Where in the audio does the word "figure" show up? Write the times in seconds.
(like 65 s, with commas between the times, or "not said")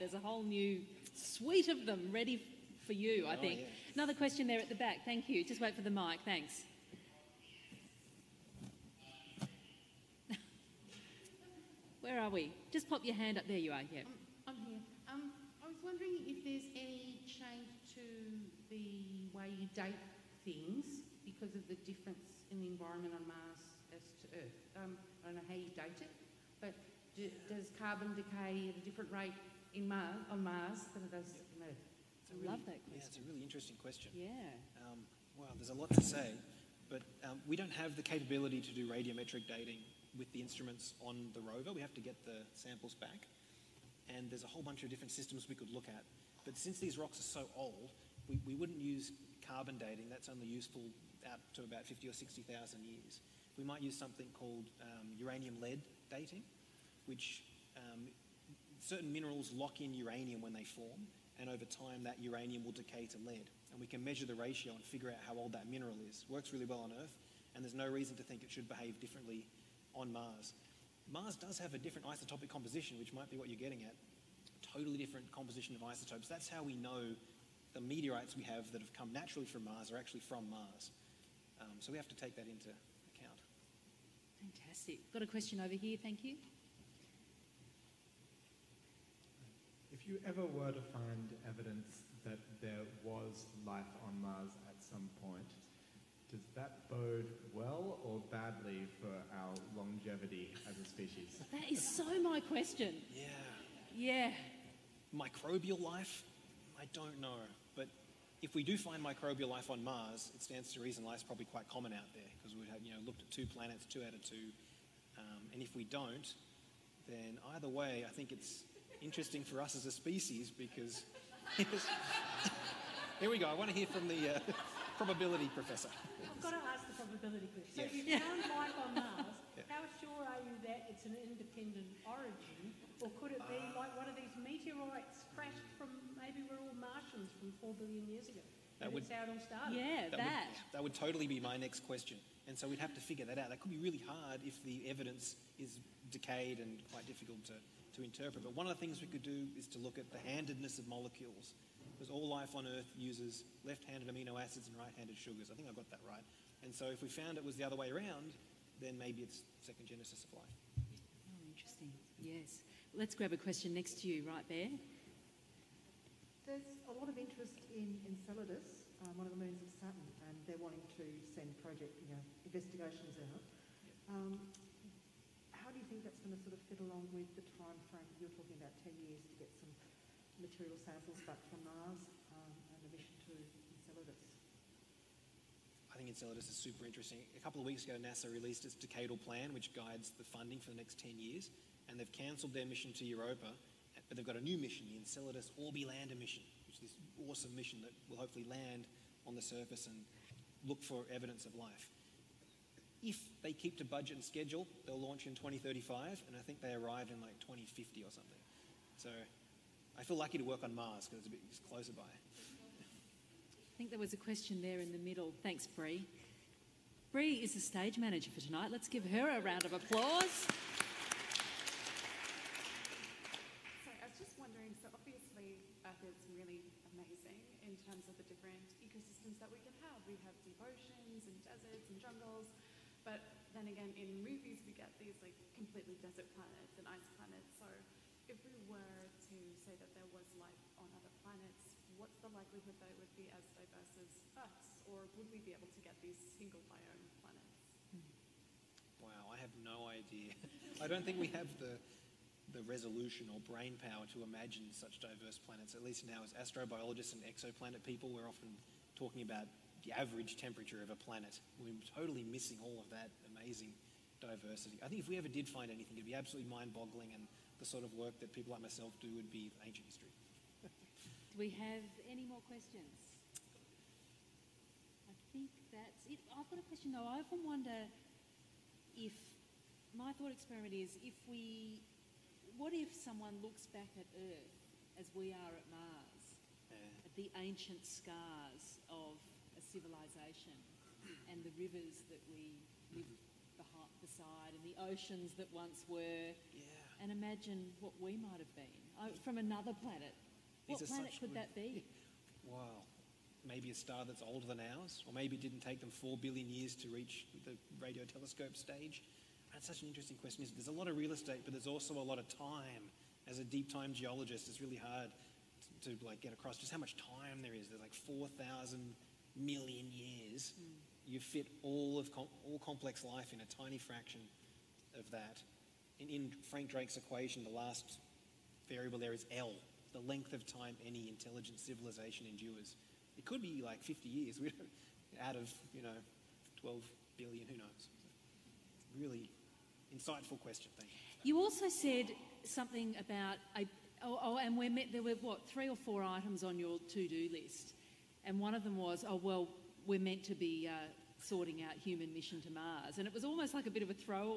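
64 s, 142 s.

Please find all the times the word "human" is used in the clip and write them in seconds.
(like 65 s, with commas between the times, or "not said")
351 s.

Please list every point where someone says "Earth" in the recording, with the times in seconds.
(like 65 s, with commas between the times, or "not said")
24 s, 31 s, 66 s, 152 s, 244 s, 284 s.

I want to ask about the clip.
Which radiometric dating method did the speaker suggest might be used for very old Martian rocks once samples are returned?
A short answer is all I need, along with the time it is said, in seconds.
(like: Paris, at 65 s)
uranium-lead dating, at 55 s.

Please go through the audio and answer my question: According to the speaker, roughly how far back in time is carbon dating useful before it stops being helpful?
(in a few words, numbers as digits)
50 or 60,000 years.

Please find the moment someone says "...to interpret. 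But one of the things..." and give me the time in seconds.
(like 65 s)
147 s.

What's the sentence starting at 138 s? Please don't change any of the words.
That would, how it all started.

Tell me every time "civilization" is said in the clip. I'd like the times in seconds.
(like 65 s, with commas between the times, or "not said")
289 s, 331 s.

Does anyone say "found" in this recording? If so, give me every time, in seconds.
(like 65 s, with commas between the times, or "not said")
128 s, 157 s.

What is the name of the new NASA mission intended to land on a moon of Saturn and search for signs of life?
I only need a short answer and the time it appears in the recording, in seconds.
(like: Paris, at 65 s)
Enceladus Orbilander, at 194 s.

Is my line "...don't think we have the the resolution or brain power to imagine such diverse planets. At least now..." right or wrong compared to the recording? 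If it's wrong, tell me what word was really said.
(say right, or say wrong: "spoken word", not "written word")
right.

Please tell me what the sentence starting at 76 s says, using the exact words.
That's how we know the meteorites we have that have come naturally from Mars are actually from Mars.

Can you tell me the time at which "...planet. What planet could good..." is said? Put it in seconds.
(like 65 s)
299 s.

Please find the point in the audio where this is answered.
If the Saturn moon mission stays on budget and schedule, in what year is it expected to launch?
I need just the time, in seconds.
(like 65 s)
205 s.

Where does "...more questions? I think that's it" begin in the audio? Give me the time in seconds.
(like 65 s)
272 s.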